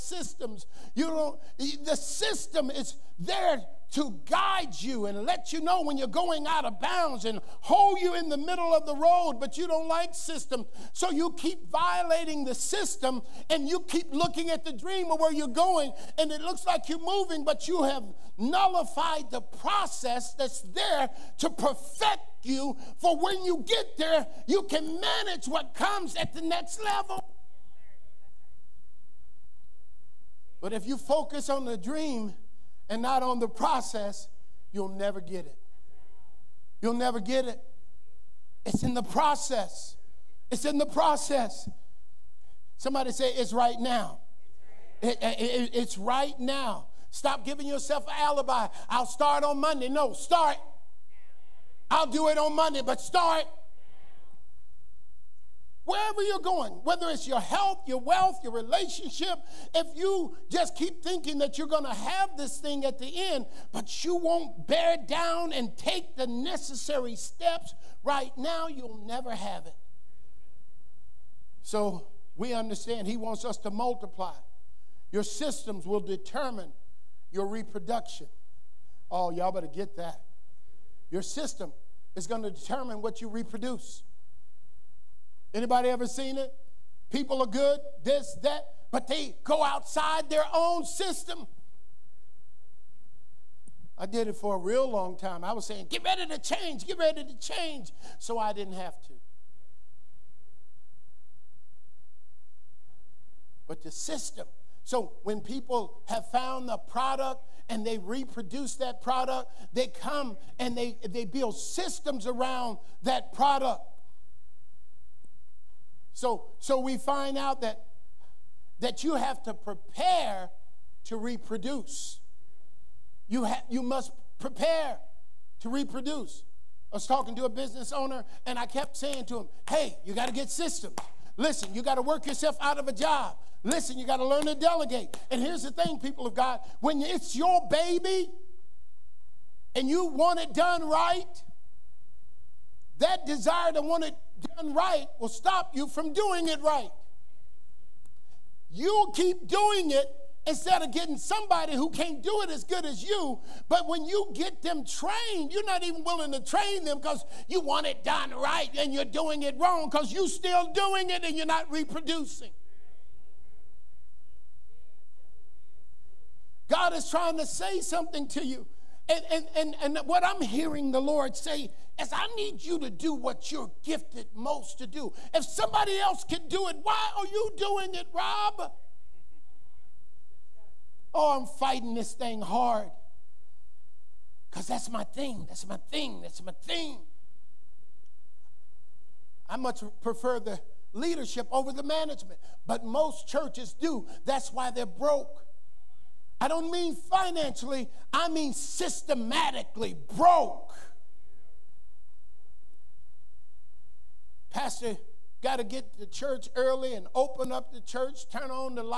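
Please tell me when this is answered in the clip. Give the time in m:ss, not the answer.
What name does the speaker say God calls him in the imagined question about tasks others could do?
2:58.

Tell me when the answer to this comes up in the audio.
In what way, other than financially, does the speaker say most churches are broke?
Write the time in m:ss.
3:18.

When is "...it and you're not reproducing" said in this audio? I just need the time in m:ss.
2:41.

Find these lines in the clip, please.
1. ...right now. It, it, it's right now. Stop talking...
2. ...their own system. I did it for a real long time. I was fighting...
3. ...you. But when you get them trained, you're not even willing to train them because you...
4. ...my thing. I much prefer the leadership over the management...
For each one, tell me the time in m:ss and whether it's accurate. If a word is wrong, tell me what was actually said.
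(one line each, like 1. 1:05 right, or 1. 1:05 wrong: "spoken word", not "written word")
1. 0:43 wrong: "giving", not "talking"
2. 1:30 wrong: "saying", not "fighting"
3. 2:33 right
4. 3:06 right.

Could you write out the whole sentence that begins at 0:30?
But if you focus on the dream, and not on the process, you'll never get it.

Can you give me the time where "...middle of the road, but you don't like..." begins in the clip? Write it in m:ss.
0:08.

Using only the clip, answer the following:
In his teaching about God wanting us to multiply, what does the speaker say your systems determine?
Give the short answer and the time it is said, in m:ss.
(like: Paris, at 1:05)
Your reproduction, at 1:17.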